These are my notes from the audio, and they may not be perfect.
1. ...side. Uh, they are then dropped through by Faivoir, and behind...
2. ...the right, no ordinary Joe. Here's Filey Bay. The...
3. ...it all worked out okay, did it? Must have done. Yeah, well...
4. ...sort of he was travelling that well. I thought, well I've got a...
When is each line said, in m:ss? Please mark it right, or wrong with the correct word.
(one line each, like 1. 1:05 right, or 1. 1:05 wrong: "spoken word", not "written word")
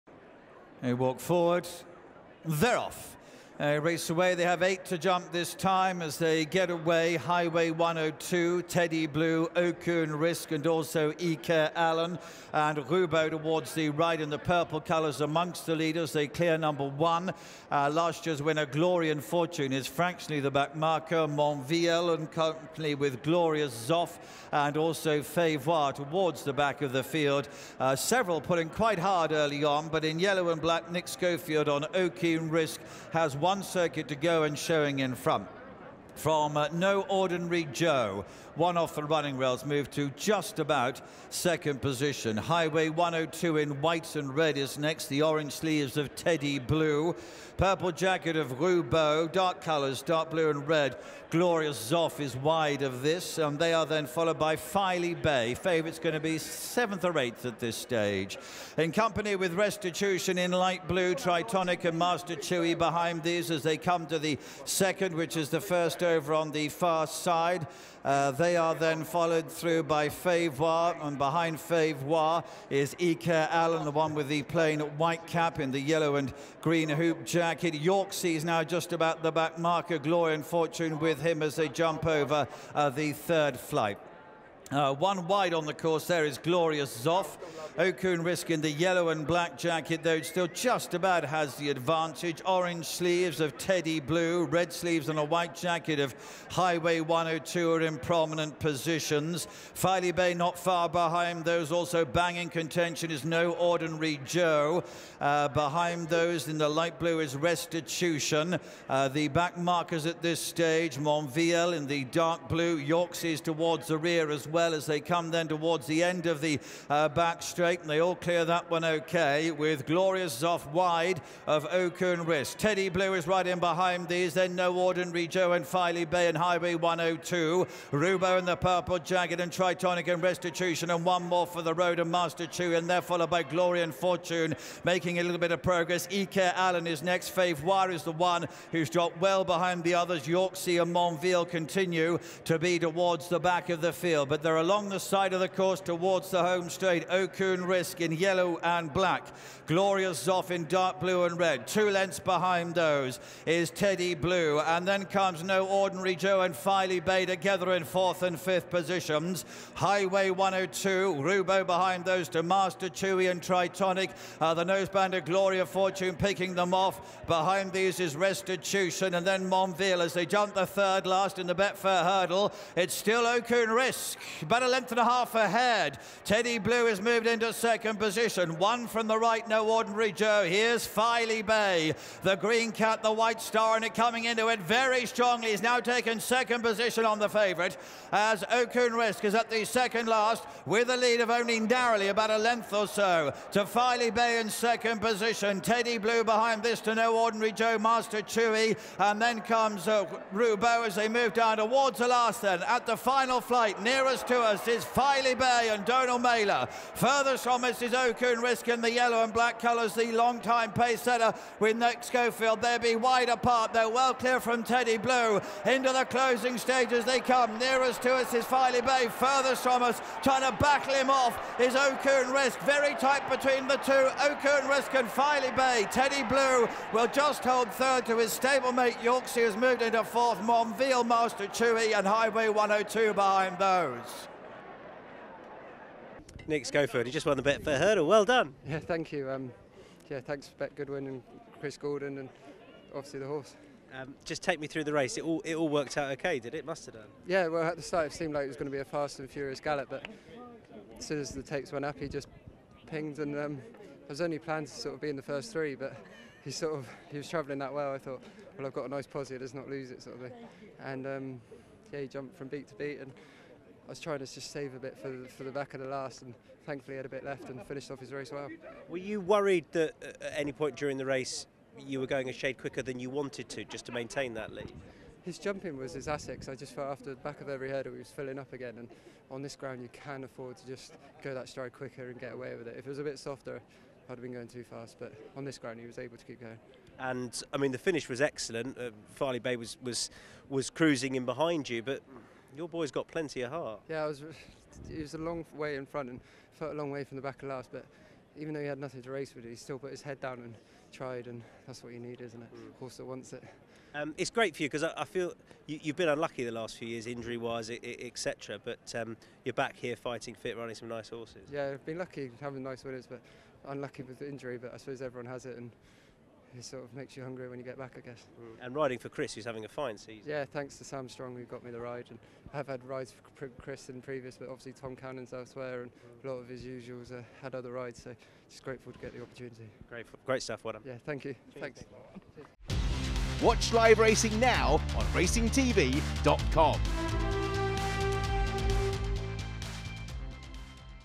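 1. 1:07 wrong: "followed", not "dropped"
2. 2:59 right
3. 4:05 right
4. 4:16 right.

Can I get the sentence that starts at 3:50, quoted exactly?
Monviel, Master Chewy, and Highway 102 behind those.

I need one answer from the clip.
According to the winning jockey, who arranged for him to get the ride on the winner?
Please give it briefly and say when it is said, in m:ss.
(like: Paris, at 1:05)
Sam Strong, at 5:20.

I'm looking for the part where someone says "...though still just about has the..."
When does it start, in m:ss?
1:30.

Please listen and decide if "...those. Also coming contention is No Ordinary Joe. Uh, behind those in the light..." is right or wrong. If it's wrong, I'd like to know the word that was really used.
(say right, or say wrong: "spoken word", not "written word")
wrong: "banging", not "coming".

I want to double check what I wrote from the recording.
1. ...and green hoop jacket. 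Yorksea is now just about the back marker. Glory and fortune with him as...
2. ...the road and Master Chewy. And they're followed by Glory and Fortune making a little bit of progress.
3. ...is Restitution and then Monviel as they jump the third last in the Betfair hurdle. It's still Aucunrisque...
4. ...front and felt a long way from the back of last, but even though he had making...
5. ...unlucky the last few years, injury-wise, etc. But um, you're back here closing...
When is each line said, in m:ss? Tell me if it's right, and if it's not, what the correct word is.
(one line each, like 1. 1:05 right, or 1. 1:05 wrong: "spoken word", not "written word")
1. 1:16 right
2. 2:11 right
3. 2:48 right
4. 4:55 wrong: "nothing", not "making"
5. 5:06 wrong: "fighting", not "closing".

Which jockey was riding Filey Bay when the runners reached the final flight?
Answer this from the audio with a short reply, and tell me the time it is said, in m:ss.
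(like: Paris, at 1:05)
Donagh Meyler, at 3:25.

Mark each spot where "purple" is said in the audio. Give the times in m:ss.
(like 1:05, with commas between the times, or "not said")
0:14, 0:47, 2:08.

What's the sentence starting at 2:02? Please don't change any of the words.
Teddy Blue is right in behind these.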